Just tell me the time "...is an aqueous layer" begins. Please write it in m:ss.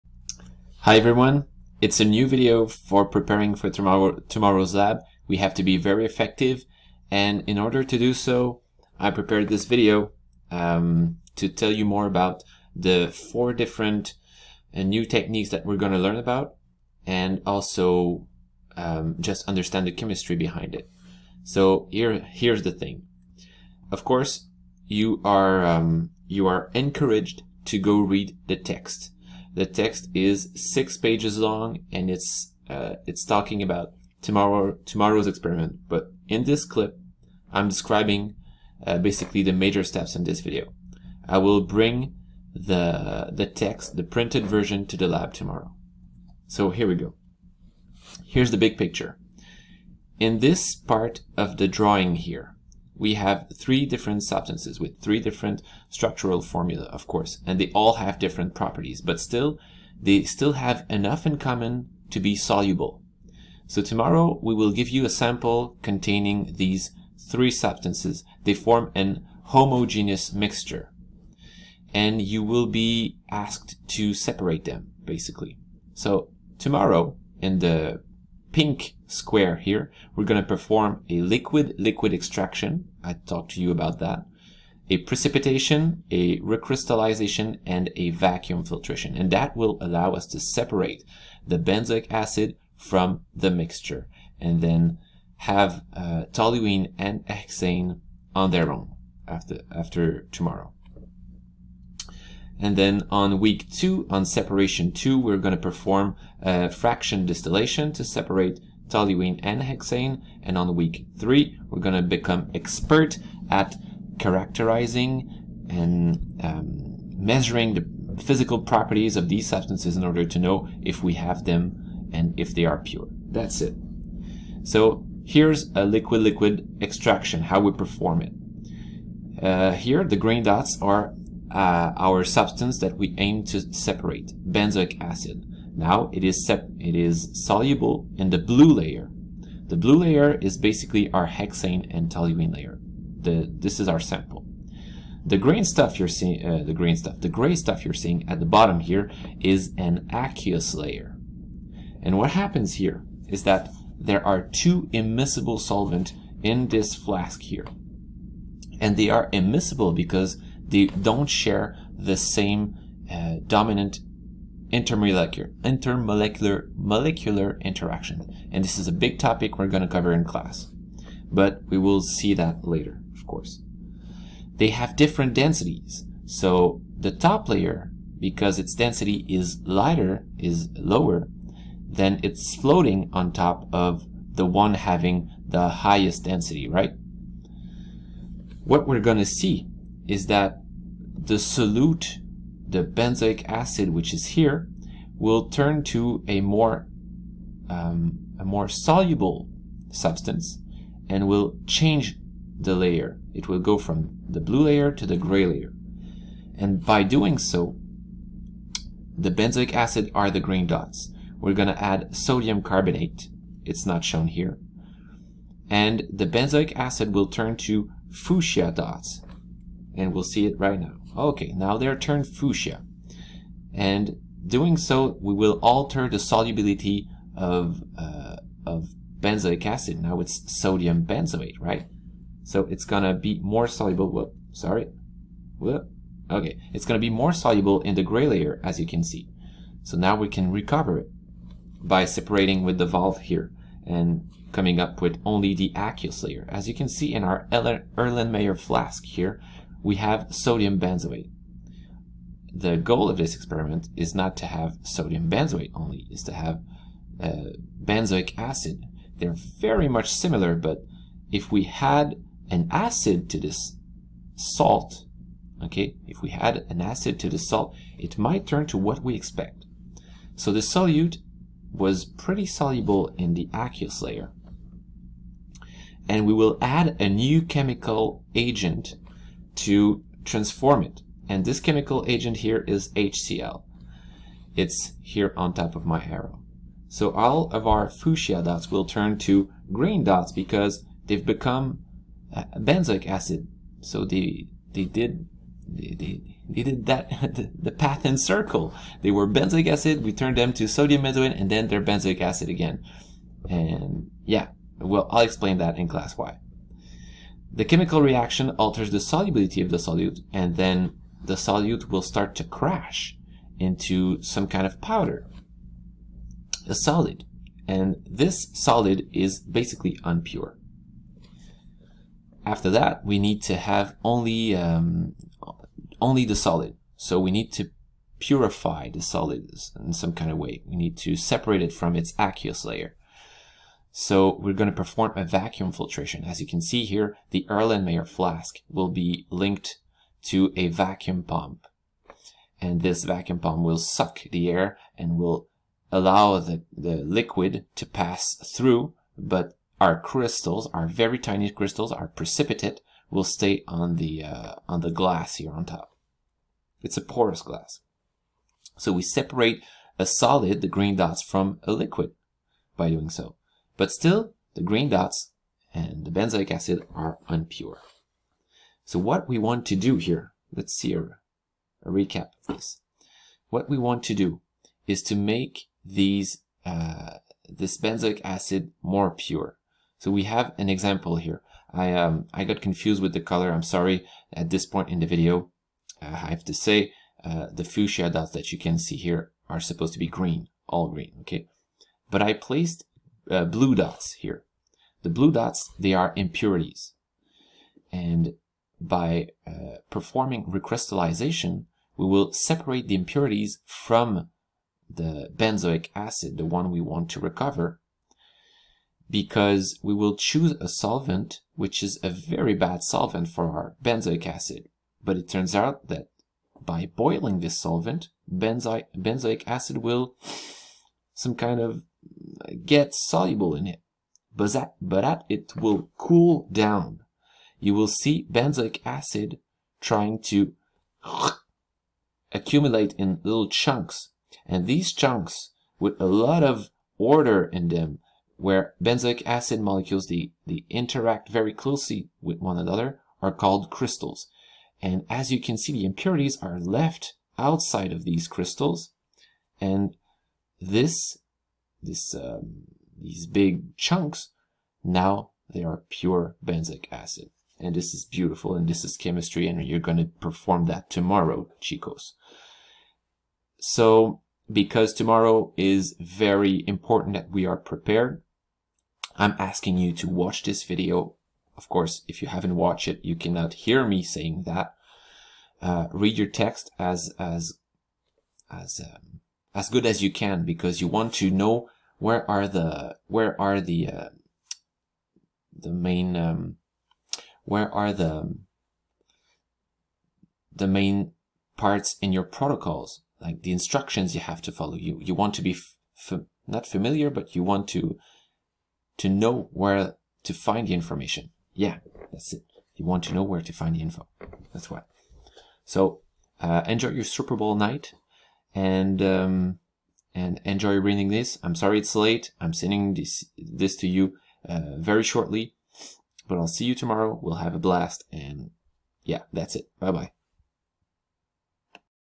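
2:29.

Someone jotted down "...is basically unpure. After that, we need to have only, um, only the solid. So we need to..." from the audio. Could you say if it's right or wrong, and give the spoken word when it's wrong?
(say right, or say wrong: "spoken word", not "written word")
right.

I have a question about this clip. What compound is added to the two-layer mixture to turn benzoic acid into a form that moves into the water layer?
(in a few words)
Sodium carbonate.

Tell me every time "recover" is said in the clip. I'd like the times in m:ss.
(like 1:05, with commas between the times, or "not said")
4:00, 6:47.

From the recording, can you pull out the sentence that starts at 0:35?
But in this clip, I'm describing uh, basically the major steps in this video.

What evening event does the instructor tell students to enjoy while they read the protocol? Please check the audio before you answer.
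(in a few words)
Super Bowl night.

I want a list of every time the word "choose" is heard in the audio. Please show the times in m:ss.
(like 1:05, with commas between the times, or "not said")
6:50.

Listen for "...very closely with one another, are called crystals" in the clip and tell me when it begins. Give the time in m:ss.
7:21.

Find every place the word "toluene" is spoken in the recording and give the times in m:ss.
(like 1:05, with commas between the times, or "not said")
1:36, 1:48, 2:22.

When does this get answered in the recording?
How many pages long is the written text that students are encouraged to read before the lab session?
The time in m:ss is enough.
0:30.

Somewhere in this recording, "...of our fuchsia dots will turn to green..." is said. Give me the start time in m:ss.
4:47.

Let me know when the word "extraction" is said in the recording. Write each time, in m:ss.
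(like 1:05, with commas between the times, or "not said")
1:22, 2:06.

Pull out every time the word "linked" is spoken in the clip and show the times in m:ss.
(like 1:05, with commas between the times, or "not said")
5:39.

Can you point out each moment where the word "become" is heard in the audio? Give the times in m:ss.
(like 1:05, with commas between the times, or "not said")
1:52, 4:51.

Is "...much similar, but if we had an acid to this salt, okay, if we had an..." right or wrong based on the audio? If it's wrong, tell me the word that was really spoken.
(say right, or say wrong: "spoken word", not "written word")
right.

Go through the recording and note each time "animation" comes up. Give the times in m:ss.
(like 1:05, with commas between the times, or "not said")
not said.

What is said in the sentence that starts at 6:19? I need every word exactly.
So we have an example here.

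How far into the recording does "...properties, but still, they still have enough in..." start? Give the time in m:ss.
0:58.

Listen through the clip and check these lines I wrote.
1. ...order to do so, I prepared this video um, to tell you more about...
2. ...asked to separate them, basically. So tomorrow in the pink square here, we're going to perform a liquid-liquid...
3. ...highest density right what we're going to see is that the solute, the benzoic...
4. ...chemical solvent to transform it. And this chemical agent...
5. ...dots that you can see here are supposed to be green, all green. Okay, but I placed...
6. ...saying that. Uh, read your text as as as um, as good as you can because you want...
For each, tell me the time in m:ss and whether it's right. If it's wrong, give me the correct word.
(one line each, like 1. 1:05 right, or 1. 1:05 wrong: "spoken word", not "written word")
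1. 0:07 right
2. 1:13 right
3. 3:05 right
4. 4:37 wrong: "agent", not "solvent"
5. 6:28 right
6. 7:54 right.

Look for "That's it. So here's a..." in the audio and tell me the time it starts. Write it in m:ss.
2:03.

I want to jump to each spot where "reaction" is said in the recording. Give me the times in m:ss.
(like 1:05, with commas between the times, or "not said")
5:08.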